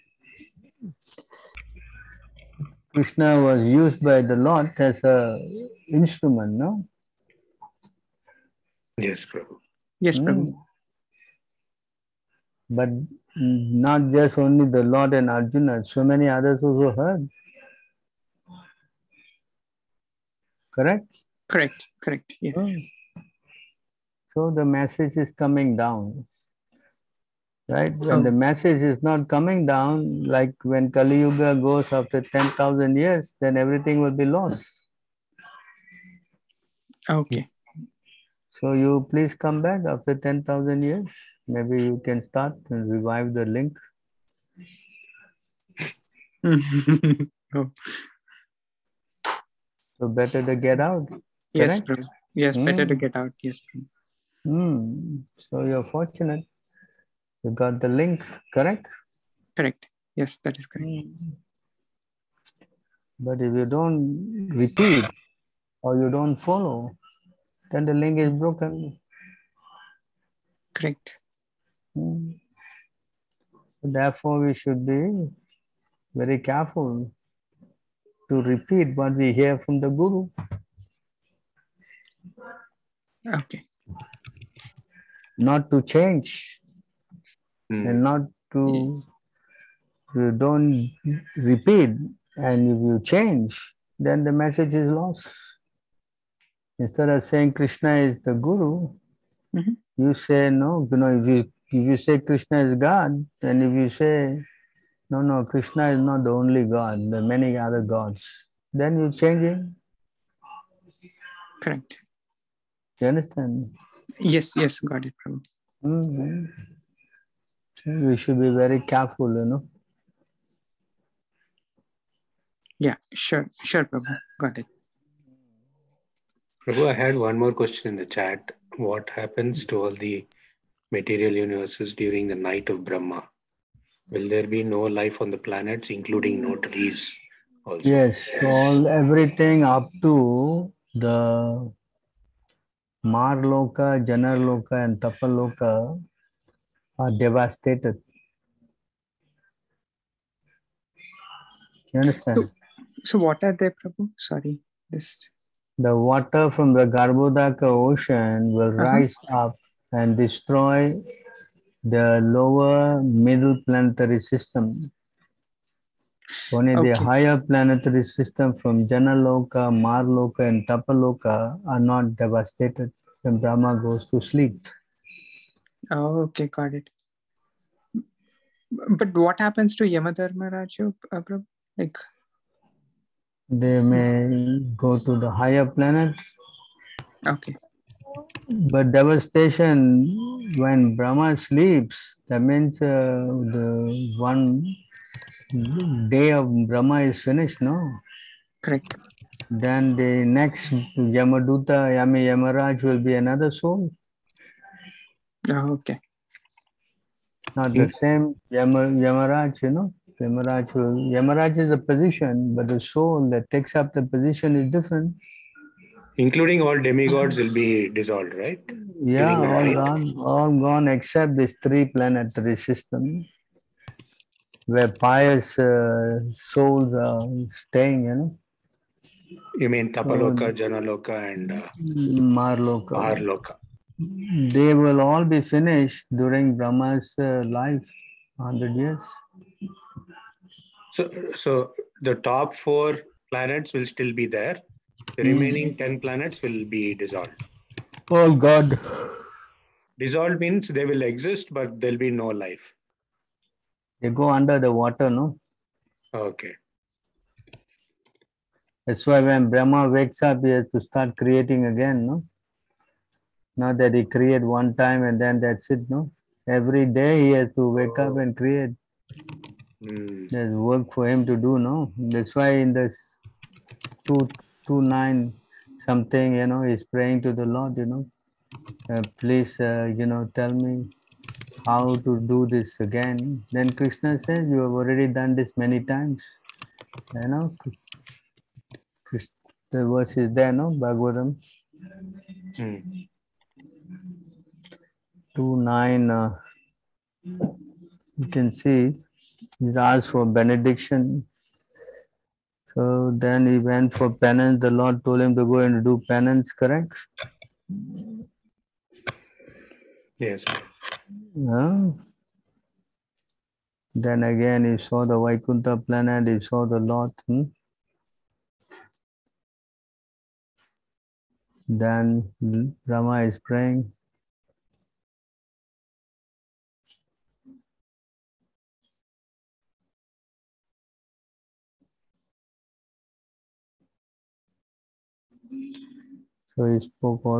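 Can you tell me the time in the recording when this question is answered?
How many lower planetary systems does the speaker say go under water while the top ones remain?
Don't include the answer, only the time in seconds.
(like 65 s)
245 s.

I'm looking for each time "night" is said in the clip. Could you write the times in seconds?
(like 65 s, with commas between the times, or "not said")
132 s.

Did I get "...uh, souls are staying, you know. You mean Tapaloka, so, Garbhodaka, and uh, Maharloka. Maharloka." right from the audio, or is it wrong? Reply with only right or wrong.
wrong.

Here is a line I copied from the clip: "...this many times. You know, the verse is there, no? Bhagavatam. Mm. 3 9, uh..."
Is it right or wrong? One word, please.
wrong.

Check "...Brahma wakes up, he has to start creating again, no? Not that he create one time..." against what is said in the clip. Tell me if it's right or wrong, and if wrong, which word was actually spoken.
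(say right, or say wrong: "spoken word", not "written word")
right.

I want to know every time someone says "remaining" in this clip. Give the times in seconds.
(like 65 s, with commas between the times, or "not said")
245 s.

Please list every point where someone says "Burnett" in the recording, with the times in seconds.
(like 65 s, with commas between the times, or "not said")
not said.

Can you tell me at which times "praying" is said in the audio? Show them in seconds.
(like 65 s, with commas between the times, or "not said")
276 s, 323 s.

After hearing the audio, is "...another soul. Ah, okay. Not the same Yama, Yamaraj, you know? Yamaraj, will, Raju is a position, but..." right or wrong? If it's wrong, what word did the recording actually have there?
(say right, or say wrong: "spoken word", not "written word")
wrong: "Yamaraj", not "Raju".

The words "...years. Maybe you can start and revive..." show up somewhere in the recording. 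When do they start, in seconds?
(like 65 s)
40 s.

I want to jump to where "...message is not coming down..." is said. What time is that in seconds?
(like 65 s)
28 s.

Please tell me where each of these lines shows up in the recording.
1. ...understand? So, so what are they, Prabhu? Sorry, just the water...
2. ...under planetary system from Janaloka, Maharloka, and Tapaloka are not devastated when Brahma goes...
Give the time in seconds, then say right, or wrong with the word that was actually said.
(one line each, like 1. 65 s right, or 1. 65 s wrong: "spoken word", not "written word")
1. 152 s right
2. 166 s wrong: "higher", not "under".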